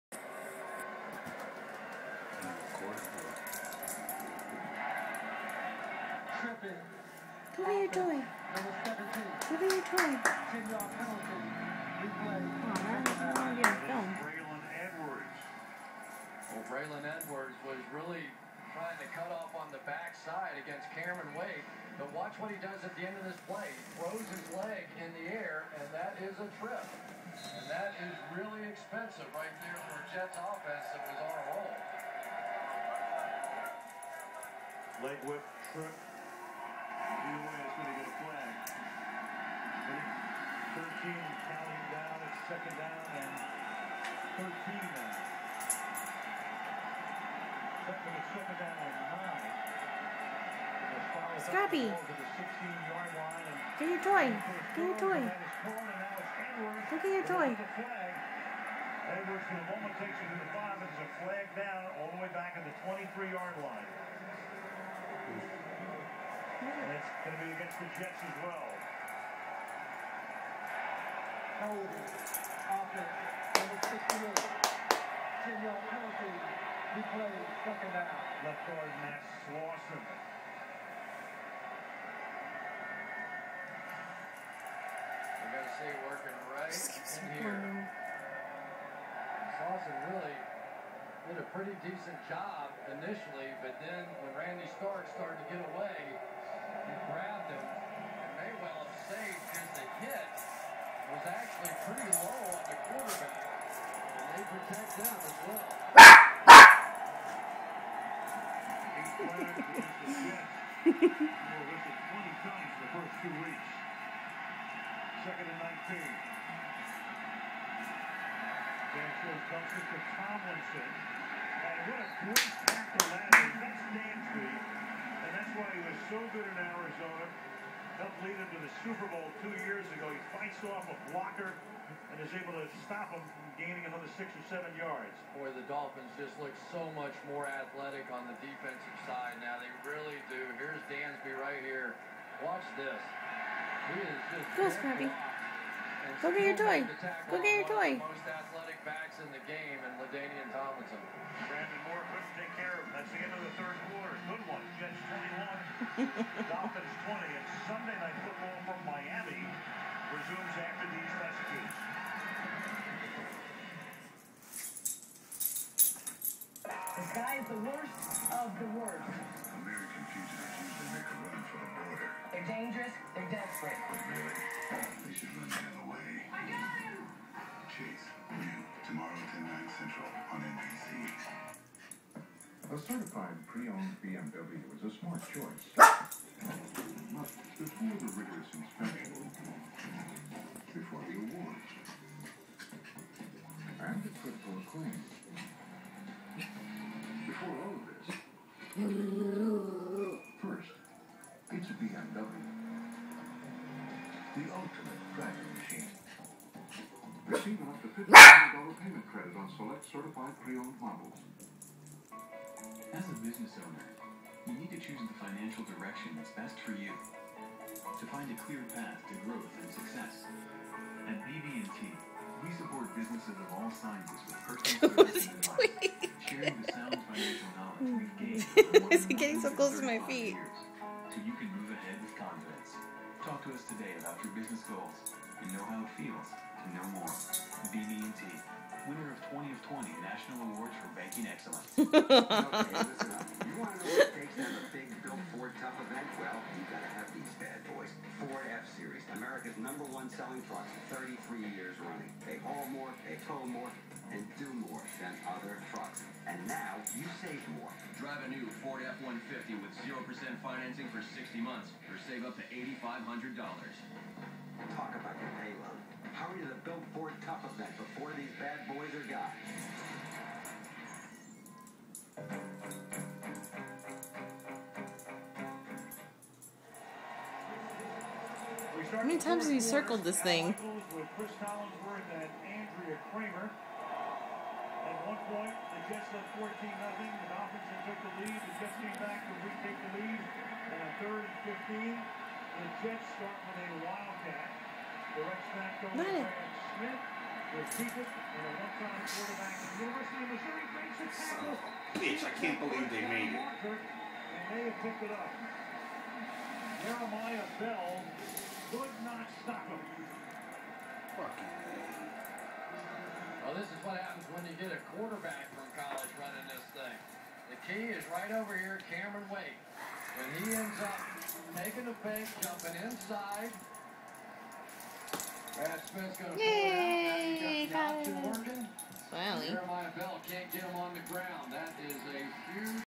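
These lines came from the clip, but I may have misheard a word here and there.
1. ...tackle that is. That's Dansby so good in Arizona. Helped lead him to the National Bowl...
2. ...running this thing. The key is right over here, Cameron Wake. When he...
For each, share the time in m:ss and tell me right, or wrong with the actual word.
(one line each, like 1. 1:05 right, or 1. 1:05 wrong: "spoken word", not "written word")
1. 2:02 wrong: "Super", not "National"
2. 5:16 right.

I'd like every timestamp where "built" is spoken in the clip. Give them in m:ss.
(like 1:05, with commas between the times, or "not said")
4:05, 4:26.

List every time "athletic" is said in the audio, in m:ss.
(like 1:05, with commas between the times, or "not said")
2:17, 2:28.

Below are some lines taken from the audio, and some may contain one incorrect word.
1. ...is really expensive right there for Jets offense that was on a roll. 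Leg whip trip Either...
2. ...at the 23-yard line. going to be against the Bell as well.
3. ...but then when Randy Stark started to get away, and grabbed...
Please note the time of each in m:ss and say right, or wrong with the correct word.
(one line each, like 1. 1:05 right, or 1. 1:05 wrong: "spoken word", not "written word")
1. 0:28 right
2. 1:02 wrong: "Jets", not "Bell"
3. 1:33 right.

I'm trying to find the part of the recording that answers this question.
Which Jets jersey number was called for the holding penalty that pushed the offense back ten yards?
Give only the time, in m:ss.
1:13.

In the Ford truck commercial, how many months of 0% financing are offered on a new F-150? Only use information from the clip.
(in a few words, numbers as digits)
60.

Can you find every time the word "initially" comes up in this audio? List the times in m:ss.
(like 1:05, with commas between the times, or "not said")
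1:32.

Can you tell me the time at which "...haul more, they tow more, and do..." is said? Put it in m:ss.
4:12.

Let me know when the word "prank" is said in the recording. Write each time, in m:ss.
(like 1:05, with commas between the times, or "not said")
not said.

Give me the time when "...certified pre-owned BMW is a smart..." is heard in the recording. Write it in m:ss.
3:02.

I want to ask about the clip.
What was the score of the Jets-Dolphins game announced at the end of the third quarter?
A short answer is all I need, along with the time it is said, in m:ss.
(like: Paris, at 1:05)
Jets 21, Dolphins 20, at 2:34.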